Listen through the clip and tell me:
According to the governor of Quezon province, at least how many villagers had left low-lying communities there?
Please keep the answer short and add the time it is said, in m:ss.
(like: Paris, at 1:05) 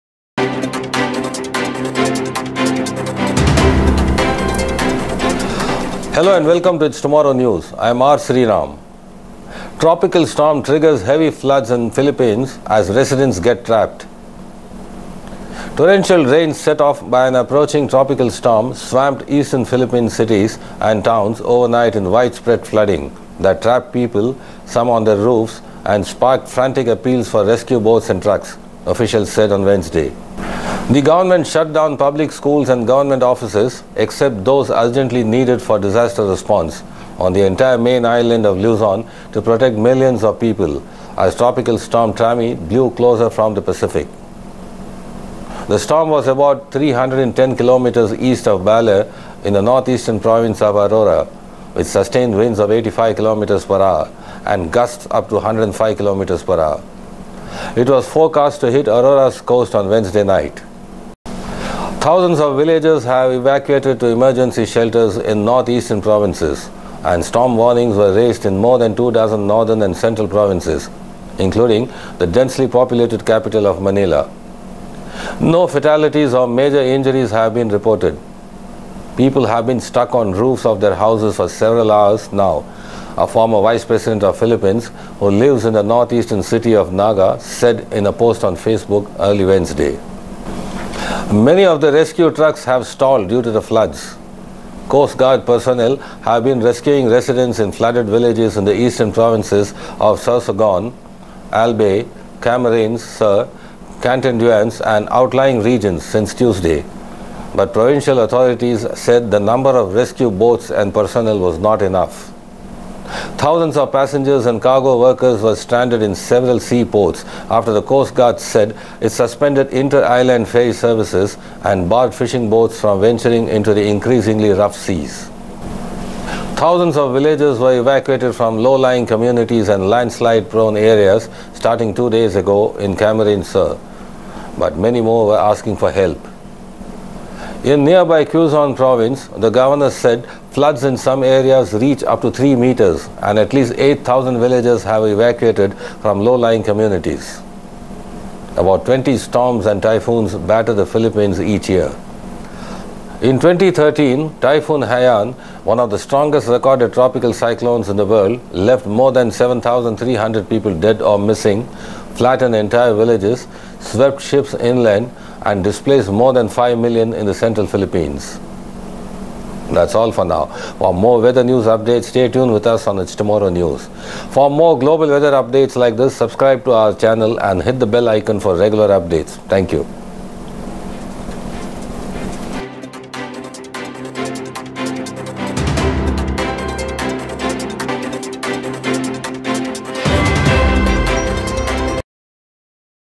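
8,000, at 2:23.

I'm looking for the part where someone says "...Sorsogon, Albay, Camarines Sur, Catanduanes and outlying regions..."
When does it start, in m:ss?
1:40.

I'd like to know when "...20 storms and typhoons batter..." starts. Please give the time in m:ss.
2:28.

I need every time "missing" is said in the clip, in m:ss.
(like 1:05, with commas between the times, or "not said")
2:41.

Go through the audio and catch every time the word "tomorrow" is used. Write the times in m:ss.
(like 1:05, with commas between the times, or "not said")
0:06, 2:53.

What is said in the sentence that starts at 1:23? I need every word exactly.
A former vice president of Philippines who lives in the northeastern city of Naga said in a post on Facebook early Wednesday.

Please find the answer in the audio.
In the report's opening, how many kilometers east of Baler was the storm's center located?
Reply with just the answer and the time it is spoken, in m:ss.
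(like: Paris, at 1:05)
310 kilometers, at 0:46.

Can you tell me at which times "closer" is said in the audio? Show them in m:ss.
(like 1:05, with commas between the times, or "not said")
0:42.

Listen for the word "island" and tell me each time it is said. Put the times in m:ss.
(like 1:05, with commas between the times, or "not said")
0:38, 1:59.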